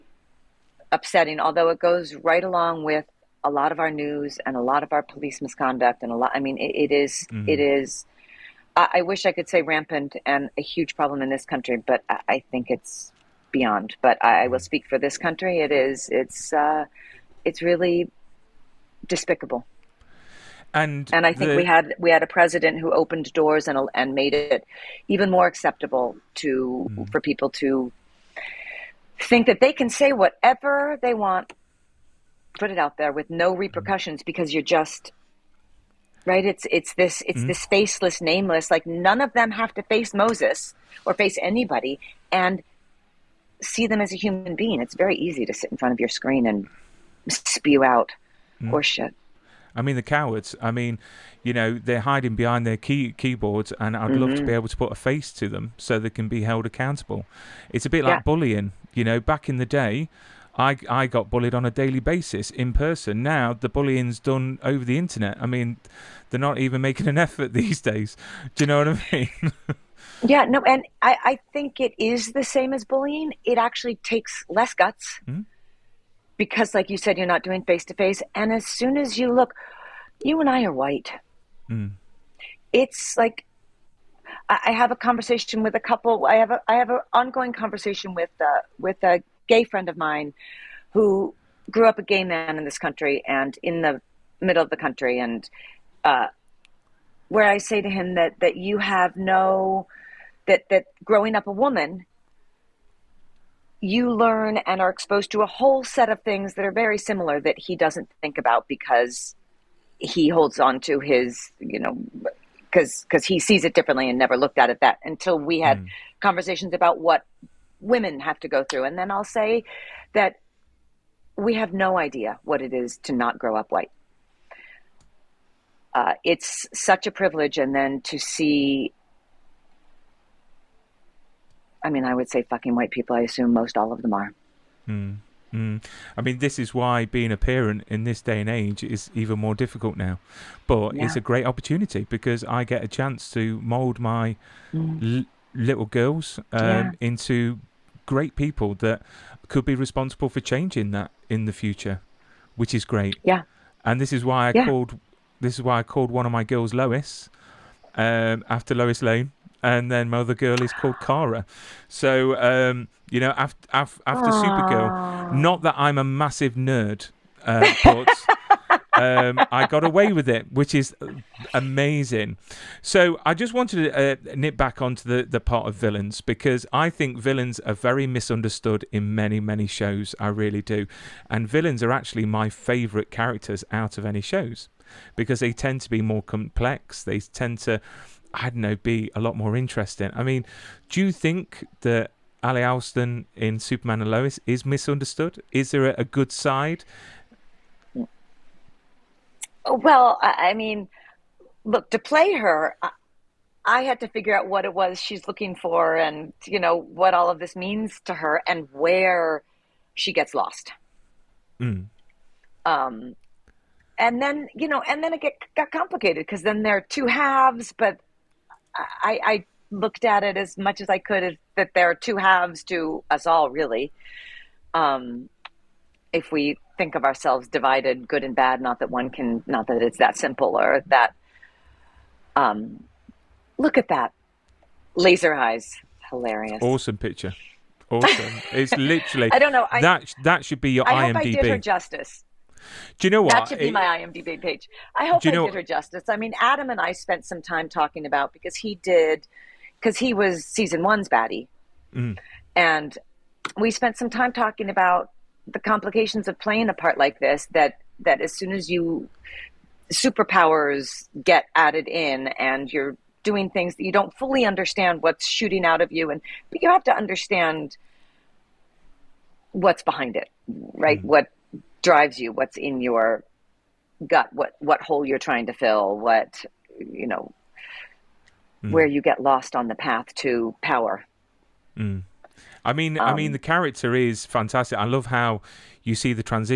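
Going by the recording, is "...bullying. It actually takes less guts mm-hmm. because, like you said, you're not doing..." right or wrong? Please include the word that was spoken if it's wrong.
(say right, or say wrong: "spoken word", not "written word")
right.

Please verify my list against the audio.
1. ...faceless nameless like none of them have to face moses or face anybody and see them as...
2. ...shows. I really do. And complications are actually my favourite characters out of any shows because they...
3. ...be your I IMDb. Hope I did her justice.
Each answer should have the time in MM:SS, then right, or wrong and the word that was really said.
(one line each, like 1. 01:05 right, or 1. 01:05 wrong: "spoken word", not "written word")
1. 00:37 right
2. 02:59 wrong: "villains", not "complications"
3. 04:00 right.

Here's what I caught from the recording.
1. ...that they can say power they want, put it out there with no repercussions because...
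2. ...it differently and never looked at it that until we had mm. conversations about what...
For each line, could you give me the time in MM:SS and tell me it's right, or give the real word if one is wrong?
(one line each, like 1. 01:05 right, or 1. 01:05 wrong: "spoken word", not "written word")
1. 00:29 wrong: "whatever", not "power"
2. 01:53 right.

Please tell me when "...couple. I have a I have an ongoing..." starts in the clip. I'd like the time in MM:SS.
01:25.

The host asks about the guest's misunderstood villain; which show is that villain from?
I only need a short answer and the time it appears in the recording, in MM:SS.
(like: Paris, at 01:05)
Superman and Lois, at 03:13.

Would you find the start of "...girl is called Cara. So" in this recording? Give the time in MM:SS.
02:40.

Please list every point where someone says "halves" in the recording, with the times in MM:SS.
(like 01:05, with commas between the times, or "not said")
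03:37, 03:42.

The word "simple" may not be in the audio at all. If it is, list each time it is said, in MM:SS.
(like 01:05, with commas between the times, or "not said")
03:50.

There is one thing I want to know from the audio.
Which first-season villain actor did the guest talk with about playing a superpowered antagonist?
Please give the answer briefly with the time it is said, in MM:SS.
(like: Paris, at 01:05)
Adam, at 04:06.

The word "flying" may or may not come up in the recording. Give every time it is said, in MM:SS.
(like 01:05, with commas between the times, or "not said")
not said.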